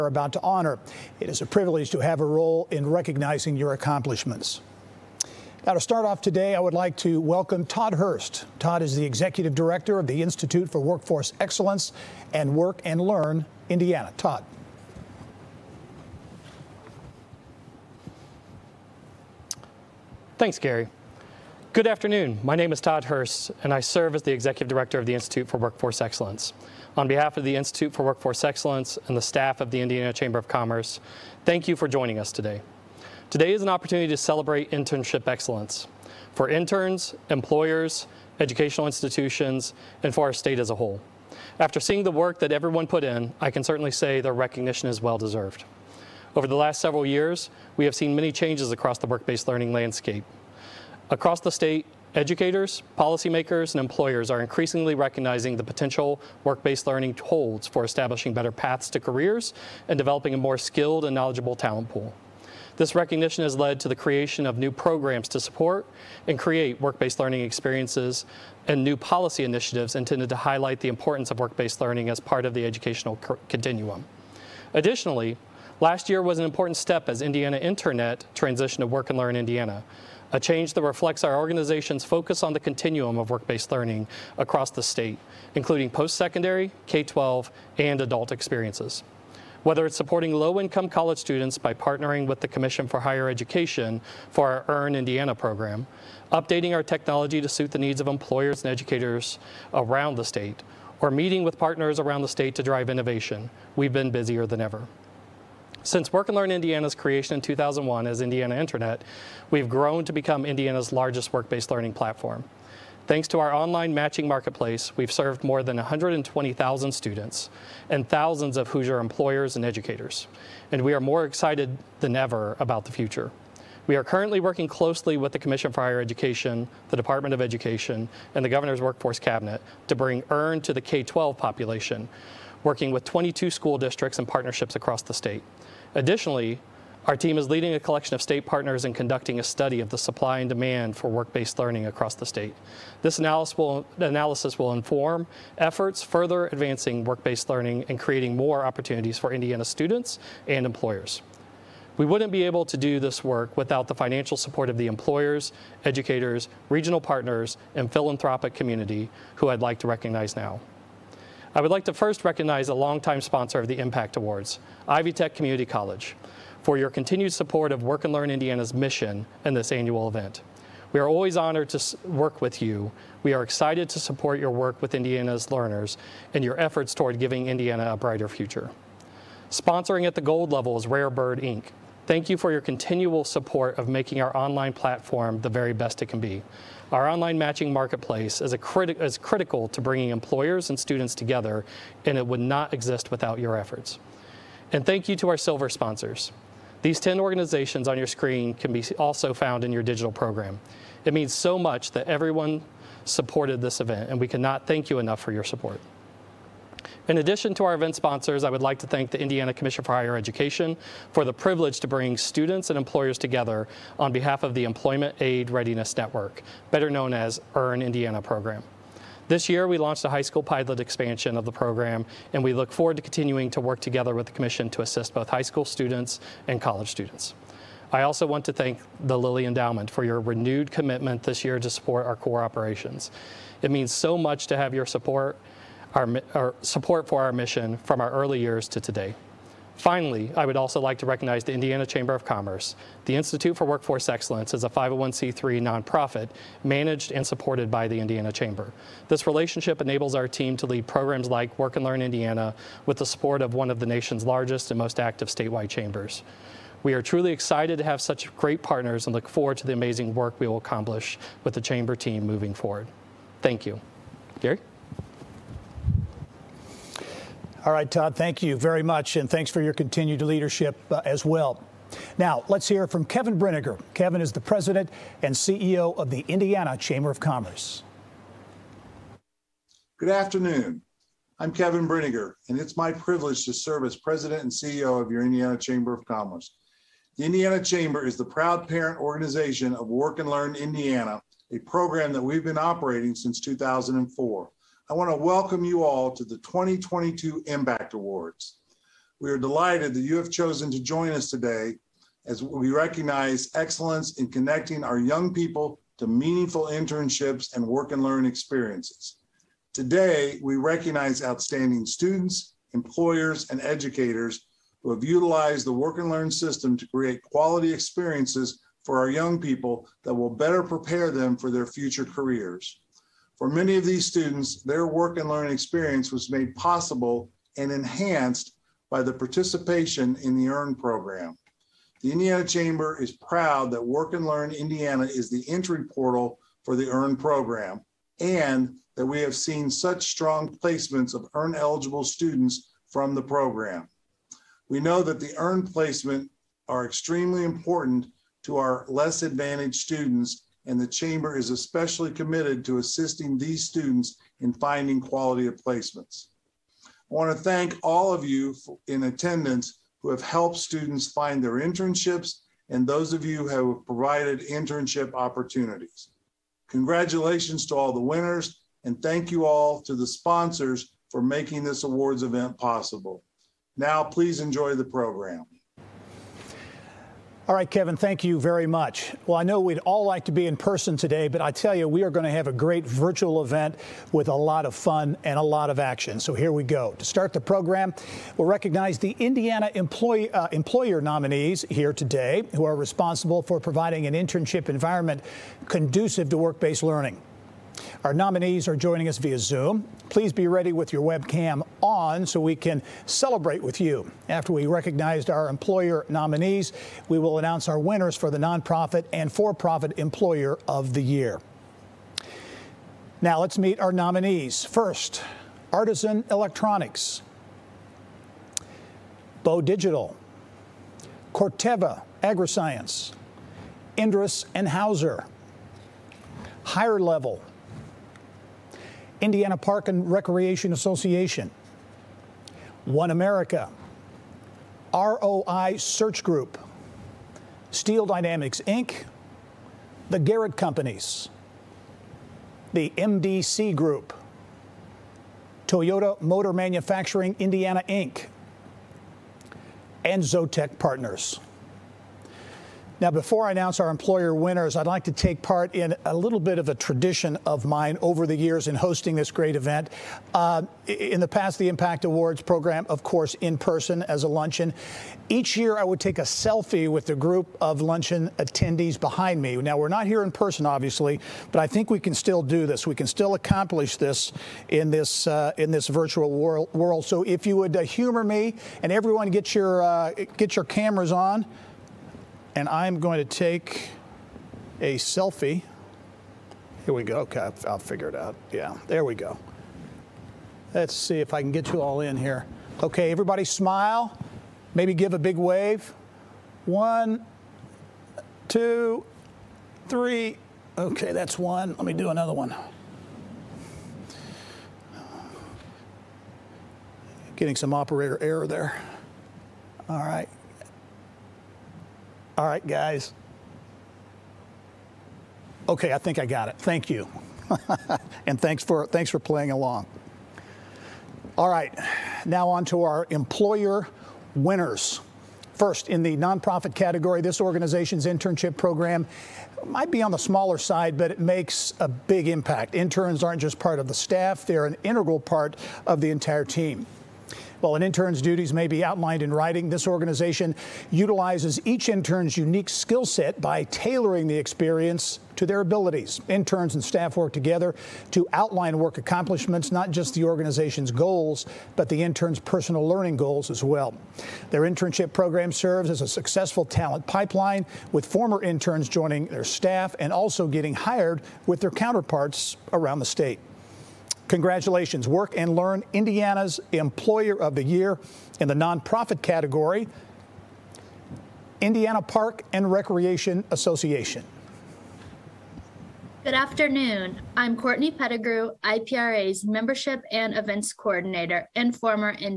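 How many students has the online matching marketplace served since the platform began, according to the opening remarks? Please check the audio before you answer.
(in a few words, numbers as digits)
More than 120,000.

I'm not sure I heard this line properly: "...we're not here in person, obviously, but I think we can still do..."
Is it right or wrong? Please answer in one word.
right.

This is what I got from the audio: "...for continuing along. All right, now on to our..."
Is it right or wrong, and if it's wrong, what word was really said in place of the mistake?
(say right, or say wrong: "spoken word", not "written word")
wrong: "playing", not "continuing".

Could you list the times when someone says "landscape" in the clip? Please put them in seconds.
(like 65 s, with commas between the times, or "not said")
49 s.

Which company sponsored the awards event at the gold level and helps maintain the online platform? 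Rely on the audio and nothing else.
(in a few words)
Rare Bird Inc.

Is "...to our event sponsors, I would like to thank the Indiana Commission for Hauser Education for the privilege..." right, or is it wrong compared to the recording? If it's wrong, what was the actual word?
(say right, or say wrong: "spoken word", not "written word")
wrong: "Higher", not "Hauser".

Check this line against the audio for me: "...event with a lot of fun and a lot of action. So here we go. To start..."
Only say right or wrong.
right.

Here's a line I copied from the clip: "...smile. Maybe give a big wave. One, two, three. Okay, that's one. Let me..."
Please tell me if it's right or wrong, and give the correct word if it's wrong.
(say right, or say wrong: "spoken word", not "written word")
right.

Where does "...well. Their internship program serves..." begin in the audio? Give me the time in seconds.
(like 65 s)
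553 s.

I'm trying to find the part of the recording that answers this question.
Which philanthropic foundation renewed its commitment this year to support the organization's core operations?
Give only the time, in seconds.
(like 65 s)
229 s.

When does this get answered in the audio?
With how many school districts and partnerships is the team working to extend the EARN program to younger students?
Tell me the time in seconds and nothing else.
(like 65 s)
133 s.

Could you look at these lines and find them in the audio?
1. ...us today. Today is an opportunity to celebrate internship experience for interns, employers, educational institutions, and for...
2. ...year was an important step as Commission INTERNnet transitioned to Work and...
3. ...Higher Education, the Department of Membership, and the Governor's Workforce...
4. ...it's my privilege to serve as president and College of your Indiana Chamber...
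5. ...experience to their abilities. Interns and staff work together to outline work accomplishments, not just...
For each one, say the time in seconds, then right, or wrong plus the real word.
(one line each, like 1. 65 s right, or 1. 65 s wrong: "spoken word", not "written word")
1. 32 s wrong: "excellence", not "experience"
2. 76 s wrong: "Indiana", not "Commission"
3. 125 s wrong: "Education", not "Membership"
4. 282 s wrong: "CEO", not "College"
5. 544 s right.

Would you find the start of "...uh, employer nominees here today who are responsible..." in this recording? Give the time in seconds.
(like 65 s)
390 s.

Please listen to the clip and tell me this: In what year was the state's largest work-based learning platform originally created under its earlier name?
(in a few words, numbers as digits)
2001.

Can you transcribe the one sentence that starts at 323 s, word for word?
For many of these students, their work and learning experience was made possible and enhanced by the participation in the EARN program.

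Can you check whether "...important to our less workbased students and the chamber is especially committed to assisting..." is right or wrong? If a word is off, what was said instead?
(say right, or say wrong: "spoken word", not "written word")
wrong: "advantaged", not "workbased".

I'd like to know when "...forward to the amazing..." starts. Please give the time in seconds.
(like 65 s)
259 s.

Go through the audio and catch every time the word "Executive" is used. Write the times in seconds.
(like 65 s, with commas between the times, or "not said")
9 s, 24 s.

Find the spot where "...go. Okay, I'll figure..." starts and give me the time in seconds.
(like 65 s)
487 s.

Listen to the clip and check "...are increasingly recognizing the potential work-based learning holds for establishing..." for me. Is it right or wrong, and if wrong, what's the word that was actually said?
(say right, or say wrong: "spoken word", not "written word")
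right.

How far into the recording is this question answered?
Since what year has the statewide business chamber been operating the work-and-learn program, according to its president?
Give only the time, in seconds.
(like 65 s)
293 s.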